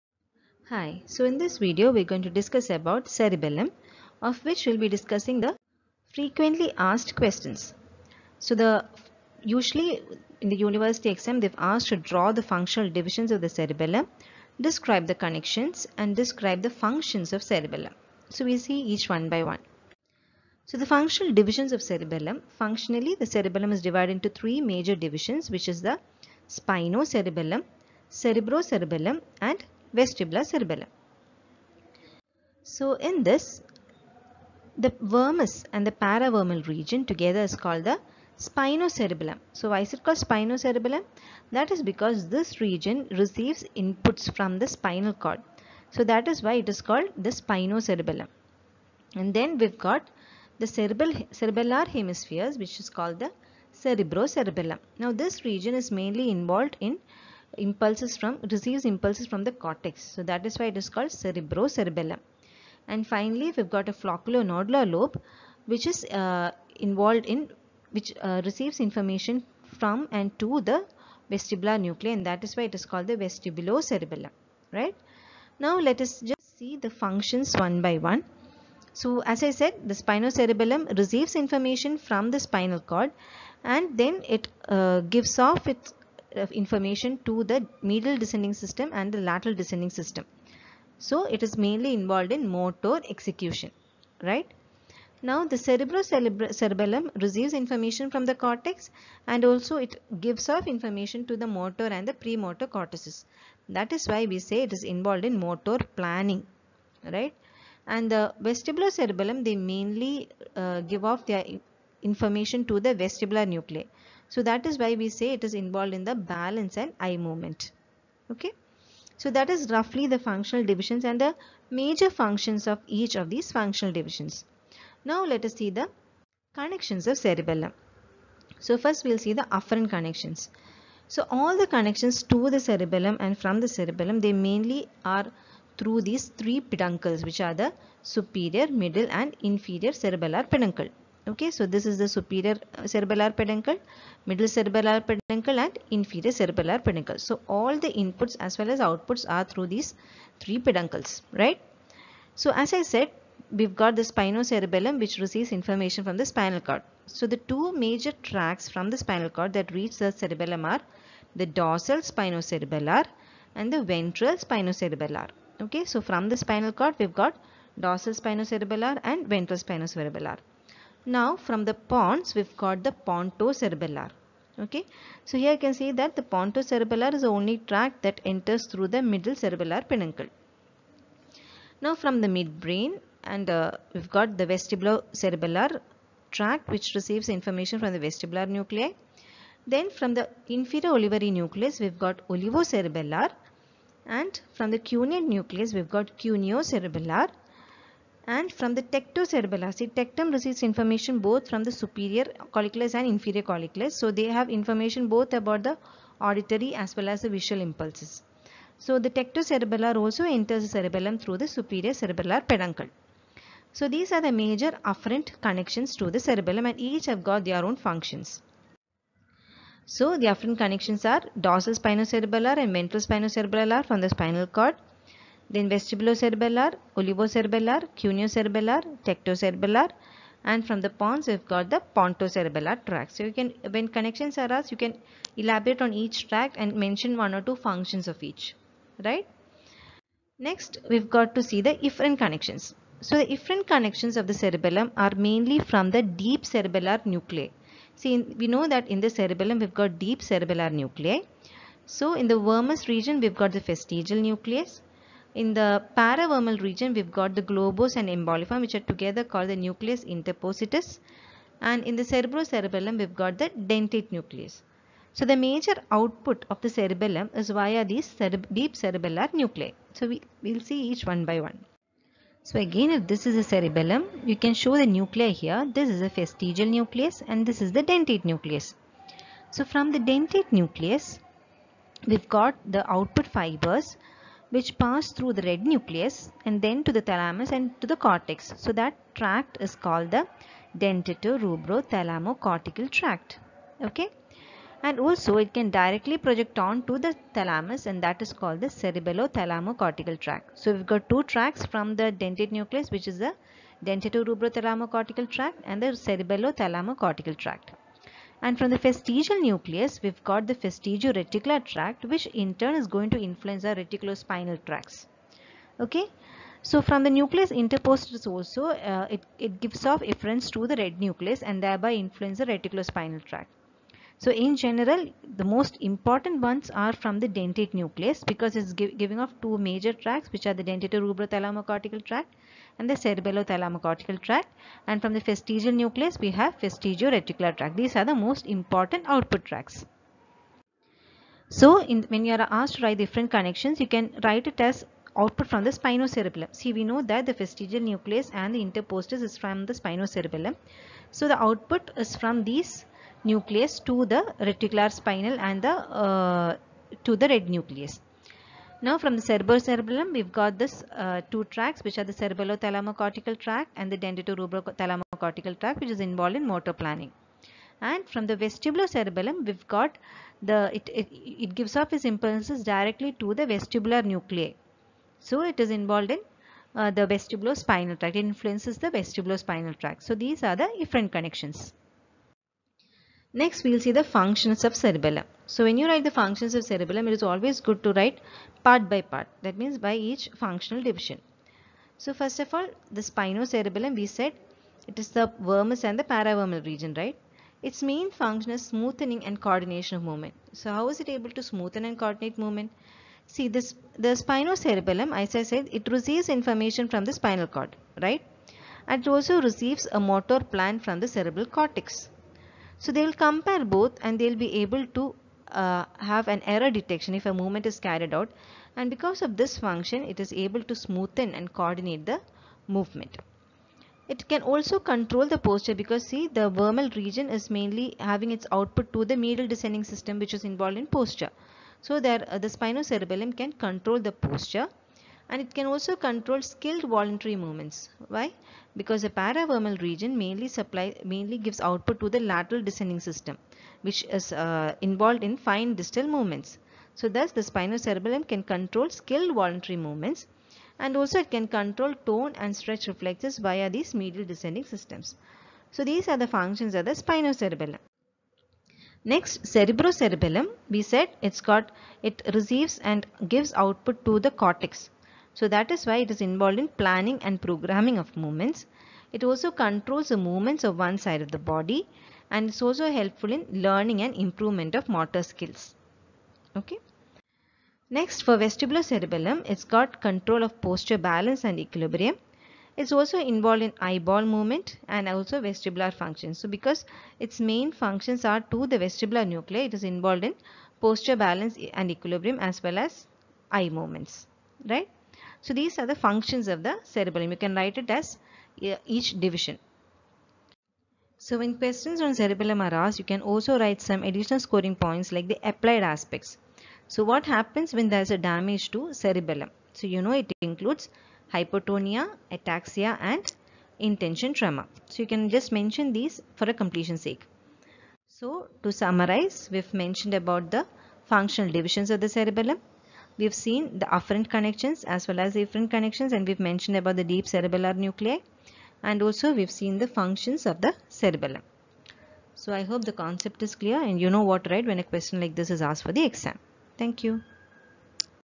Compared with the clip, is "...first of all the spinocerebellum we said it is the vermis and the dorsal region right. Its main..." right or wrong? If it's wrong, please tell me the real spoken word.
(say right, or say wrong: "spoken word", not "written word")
wrong: "paravermal", not "dorsal".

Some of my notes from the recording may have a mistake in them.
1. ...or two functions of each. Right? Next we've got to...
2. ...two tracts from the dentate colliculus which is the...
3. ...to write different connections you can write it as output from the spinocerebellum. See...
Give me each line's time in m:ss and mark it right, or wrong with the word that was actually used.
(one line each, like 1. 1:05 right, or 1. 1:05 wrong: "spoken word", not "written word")
1. 3:57 right
2. 5:01 wrong: "nucleus", not "colliculus"
3. 5:42 right.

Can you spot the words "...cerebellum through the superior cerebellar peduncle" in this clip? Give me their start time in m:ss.
3:30.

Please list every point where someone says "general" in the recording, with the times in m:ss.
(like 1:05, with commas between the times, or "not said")
5:24.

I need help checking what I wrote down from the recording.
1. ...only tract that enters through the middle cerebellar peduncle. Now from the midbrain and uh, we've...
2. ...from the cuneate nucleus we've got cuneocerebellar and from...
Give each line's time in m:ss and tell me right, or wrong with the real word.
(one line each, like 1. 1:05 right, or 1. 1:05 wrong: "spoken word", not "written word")
1. 2:57 right
2. 3:14 right.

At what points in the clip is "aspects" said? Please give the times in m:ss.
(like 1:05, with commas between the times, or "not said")
8:25.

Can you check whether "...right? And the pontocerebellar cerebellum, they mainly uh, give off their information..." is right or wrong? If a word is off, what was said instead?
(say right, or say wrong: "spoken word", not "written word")
wrong: "vestibular", not "pontocerebellar".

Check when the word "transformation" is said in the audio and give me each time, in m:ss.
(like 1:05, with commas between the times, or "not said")
not said.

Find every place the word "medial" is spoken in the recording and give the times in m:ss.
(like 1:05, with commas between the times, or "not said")
1:27, 7:09, 7:34.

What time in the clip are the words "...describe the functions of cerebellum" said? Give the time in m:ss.
0:16.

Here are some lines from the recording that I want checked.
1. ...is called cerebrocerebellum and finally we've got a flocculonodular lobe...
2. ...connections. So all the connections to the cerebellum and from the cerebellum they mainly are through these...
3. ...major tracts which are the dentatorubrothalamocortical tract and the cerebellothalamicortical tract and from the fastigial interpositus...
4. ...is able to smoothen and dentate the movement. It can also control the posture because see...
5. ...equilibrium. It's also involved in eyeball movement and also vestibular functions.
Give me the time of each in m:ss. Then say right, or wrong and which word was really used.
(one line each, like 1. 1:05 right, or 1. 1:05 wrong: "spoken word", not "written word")
1. 1:00 right
2. 2:09 right
3. 5:29 wrong: "nucleus", not "interpositus"
4. 7:00 wrong: "coordinate", not "dentate"
5. 8:01 right.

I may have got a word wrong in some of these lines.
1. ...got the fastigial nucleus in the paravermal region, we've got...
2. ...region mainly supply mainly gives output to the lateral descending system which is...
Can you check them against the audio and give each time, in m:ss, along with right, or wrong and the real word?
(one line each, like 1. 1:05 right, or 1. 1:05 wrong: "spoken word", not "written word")
1. 4:13 right
2. 7:19 right.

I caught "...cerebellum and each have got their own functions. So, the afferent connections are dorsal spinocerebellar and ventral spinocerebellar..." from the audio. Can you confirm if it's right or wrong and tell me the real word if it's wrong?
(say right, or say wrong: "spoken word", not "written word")
right.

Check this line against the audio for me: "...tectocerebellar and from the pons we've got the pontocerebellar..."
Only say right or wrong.
right.